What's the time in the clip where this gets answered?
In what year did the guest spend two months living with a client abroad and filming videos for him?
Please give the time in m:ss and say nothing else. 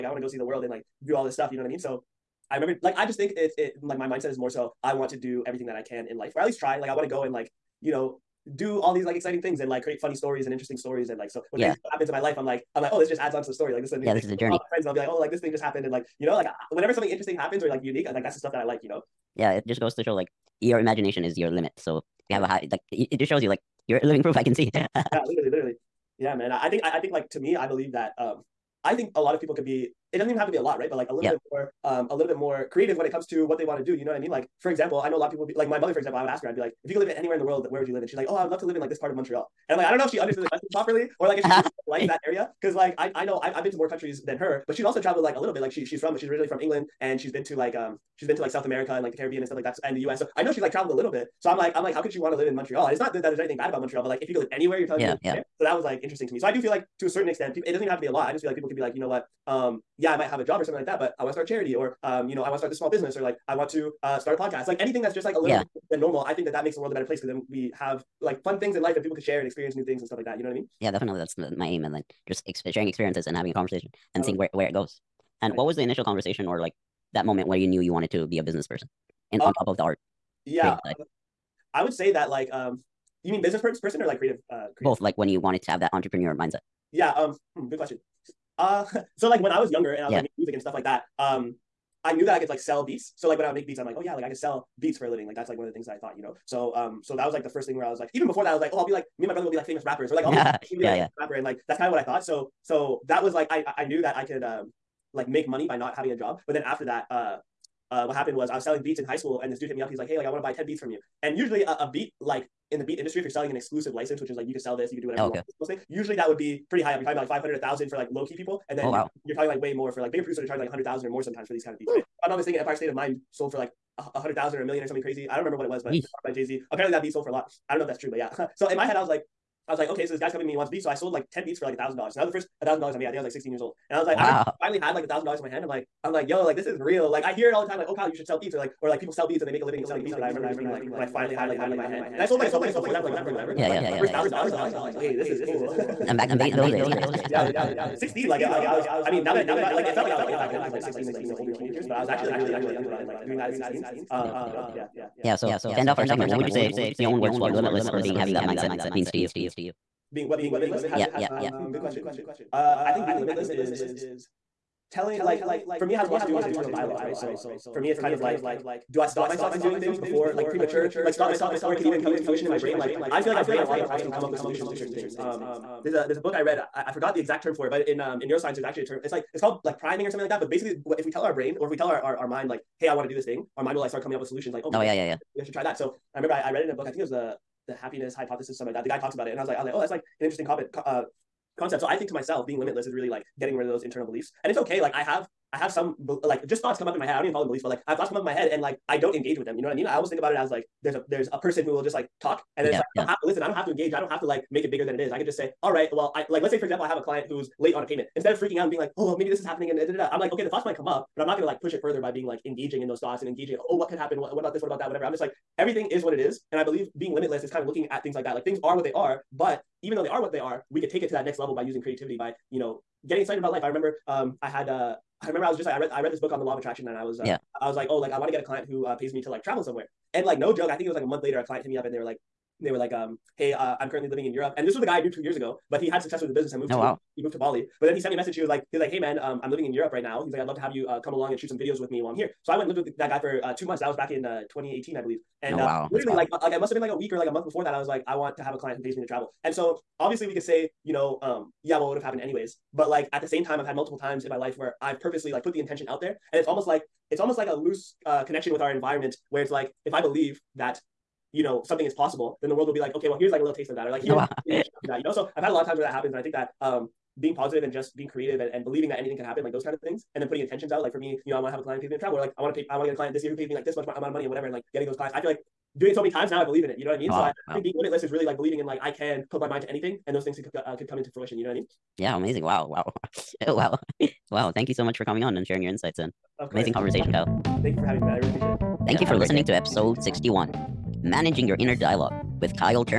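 4:04.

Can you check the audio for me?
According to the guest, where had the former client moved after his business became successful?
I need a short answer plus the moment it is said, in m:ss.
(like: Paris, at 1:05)
Bali, at 3:57.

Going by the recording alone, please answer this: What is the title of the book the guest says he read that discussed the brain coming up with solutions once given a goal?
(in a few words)
The Happiness Hypothesis.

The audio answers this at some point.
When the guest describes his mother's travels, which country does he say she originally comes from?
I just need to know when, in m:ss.
0:46.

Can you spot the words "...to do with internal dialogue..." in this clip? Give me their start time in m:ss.
2:46.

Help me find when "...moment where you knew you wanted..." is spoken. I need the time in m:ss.
1:17.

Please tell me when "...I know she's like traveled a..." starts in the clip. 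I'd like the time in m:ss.
0:50.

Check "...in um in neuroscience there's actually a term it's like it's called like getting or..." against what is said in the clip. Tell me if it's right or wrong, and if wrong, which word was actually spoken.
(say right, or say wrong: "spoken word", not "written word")
wrong: "priming", not "getting".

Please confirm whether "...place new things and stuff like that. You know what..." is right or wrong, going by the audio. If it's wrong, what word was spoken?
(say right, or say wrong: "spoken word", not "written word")
wrong: "experience", not "place".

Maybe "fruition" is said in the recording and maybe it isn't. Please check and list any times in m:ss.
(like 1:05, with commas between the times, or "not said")
2:52, 4:41.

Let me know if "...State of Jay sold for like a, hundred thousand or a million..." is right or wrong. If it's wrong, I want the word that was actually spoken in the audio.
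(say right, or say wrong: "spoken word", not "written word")
wrong: "Mind", not "Jay".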